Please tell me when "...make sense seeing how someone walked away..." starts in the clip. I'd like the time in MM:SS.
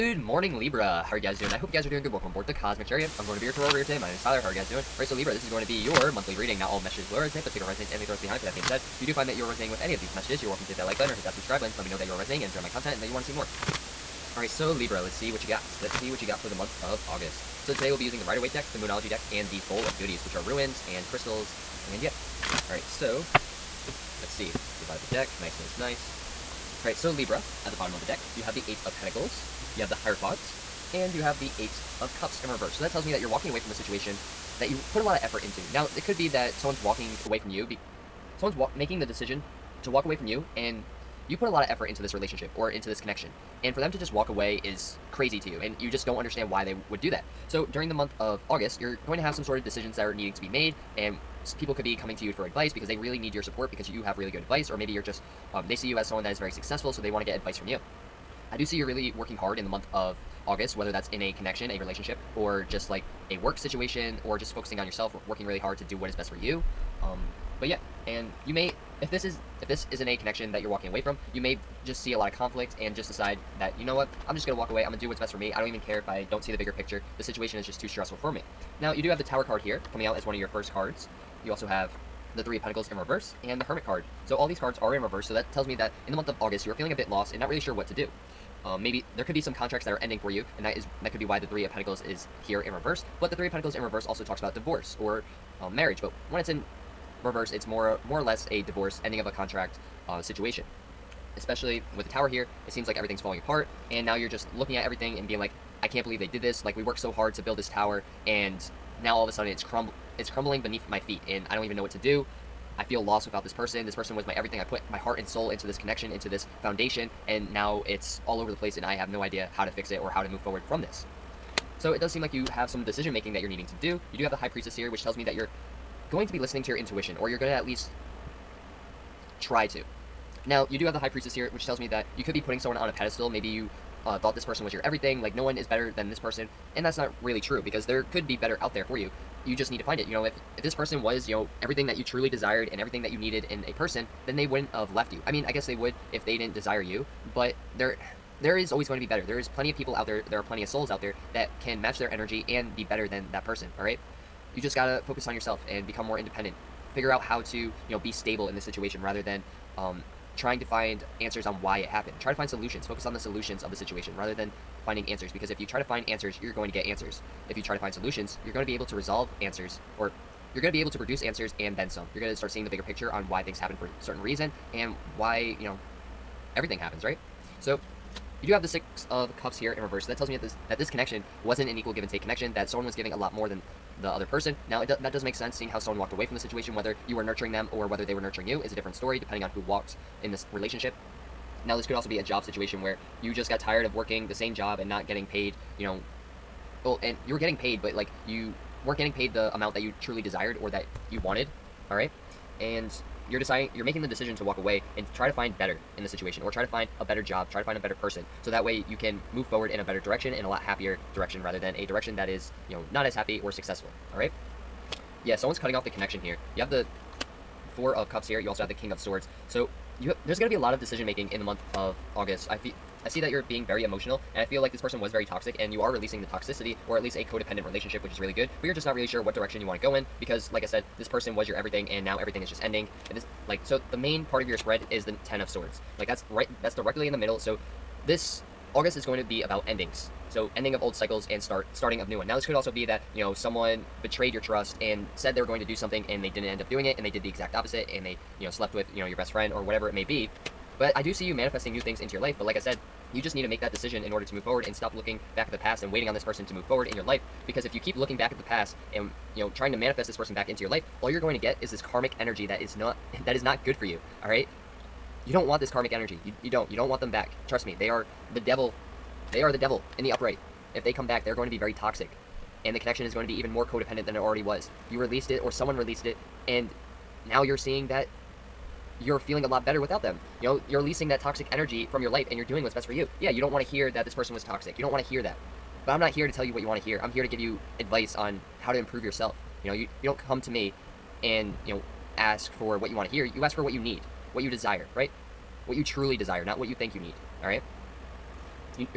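03:05.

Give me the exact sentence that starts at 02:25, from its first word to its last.
I mean, I guess they would if they didn't desire you, but there there is always going to be better.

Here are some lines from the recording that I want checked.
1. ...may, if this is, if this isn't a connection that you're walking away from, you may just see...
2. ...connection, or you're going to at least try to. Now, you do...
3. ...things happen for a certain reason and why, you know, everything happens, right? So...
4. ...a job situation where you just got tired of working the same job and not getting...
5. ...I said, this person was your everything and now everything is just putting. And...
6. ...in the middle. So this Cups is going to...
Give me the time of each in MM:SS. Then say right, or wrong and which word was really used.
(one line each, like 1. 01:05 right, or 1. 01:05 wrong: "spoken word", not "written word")
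1. 01:08 right
2. 02:06 wrong: "intuition", not "connection"
3. 02:53 right
4. 03:12 right
5. 03:50 wrong: "ending", not "putting"
6. 03:57 wrong: "August", not "Cups".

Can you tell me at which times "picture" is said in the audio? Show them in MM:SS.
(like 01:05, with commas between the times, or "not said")
01:16, 02:52.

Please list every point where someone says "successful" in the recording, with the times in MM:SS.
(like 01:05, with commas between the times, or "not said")
00:56, 03:33.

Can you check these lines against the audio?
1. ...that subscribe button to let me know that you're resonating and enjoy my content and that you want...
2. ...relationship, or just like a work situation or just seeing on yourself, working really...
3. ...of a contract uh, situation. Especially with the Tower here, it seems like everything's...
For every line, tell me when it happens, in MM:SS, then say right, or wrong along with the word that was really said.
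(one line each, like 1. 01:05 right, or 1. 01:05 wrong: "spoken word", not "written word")
1. 00:11 right
2. 01:01 wrong: "focusing", not "seeing"
3. 01:39 right.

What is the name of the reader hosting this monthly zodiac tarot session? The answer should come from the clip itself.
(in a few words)
Tyler.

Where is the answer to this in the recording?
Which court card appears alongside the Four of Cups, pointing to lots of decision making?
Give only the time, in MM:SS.
03:38.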